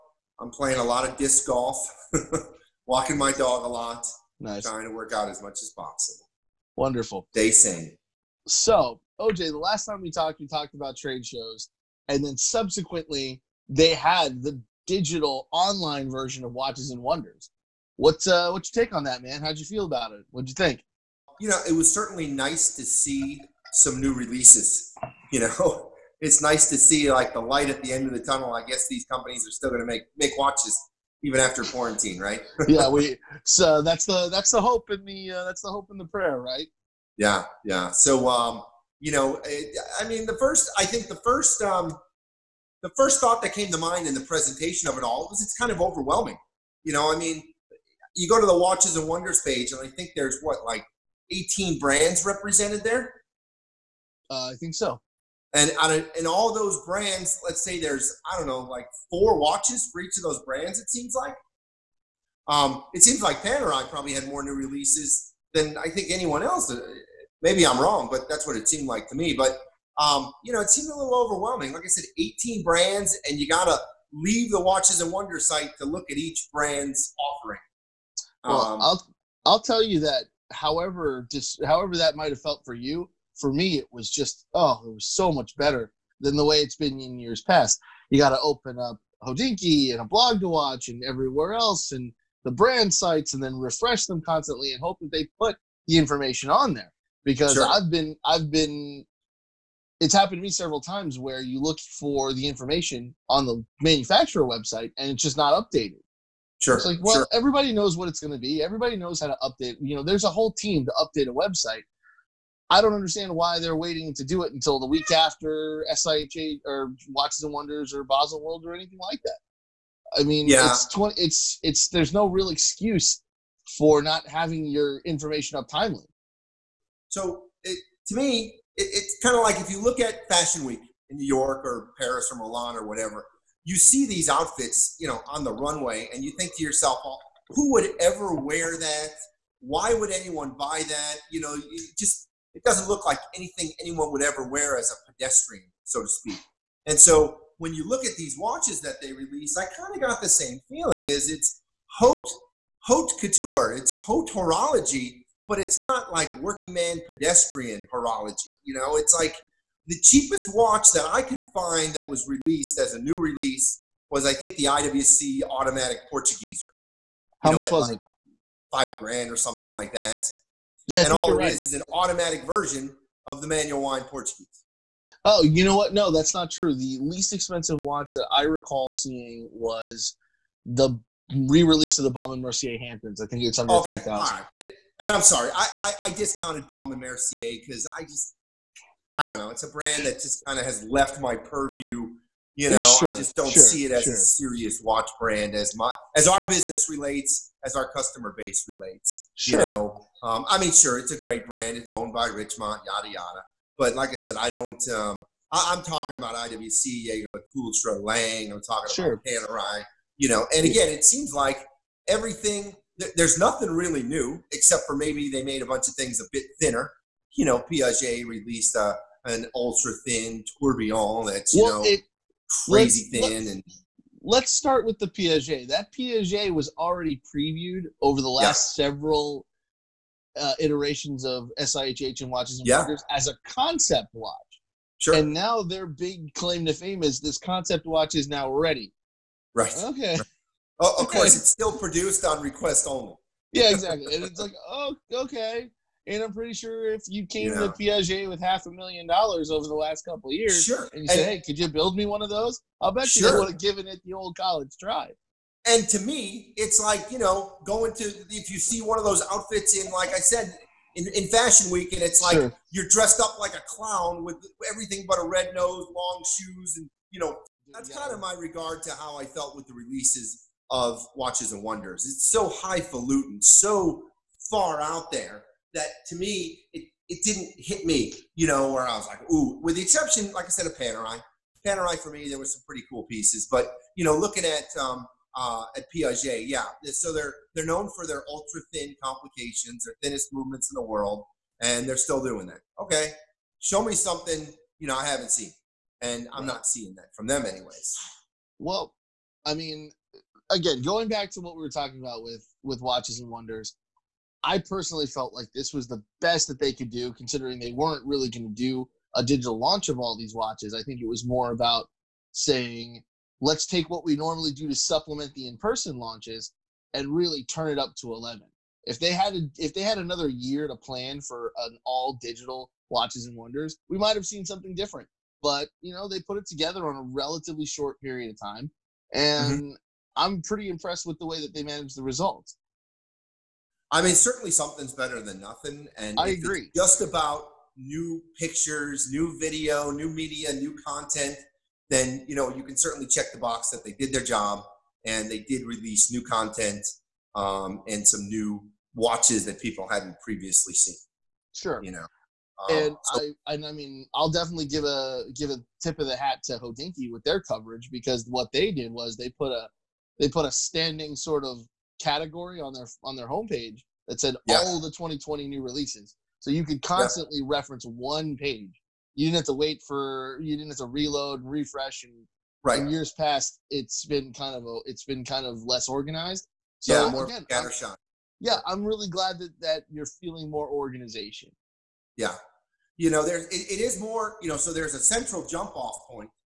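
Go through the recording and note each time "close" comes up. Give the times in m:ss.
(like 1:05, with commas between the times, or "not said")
not said.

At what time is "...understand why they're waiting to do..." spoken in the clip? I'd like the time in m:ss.
1:52.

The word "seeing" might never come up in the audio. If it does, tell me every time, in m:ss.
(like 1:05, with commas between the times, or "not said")
2:58, 4:56.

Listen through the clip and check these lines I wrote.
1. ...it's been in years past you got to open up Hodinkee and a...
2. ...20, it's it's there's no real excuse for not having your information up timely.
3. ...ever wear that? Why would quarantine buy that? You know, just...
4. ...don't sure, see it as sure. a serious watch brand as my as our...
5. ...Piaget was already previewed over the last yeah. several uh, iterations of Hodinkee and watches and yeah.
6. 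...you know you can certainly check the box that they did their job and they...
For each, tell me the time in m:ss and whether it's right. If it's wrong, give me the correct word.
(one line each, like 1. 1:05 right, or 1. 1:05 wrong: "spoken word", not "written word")
1. 1:26 right
2. 2:00 right
3. 2:18 wrong: "anyone", not "quarantine"
4. 3:13 right
5. 3:45 wrong: "SIHH", not "Hodinkee"
6. 5:42 right.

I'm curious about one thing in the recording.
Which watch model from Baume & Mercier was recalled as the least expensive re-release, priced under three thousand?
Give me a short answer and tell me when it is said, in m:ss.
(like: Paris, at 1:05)
Hamptons, at 3:02.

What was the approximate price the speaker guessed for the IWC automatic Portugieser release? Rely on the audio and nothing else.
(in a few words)
Five grand.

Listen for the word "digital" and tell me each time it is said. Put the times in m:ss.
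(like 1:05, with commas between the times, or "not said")
0:14, 5:09, 5:22.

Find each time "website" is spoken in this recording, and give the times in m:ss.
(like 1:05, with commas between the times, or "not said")
1:44, 1:51.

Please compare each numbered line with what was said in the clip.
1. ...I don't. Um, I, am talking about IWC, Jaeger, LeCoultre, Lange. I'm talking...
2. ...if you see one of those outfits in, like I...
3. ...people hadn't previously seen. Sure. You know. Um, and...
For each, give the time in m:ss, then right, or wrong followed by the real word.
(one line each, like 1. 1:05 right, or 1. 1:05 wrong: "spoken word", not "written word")
1. 3:24 right
2. 4:18 right
3. 5:49 right.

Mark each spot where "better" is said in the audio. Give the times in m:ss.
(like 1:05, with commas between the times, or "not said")
1:25, 5:34.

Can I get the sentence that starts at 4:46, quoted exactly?
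So they're they're known for their ultra thin complications, their thinnest movements in the world, and they're still doing that.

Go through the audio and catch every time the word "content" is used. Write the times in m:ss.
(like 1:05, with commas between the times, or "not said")
5:40, 5:46.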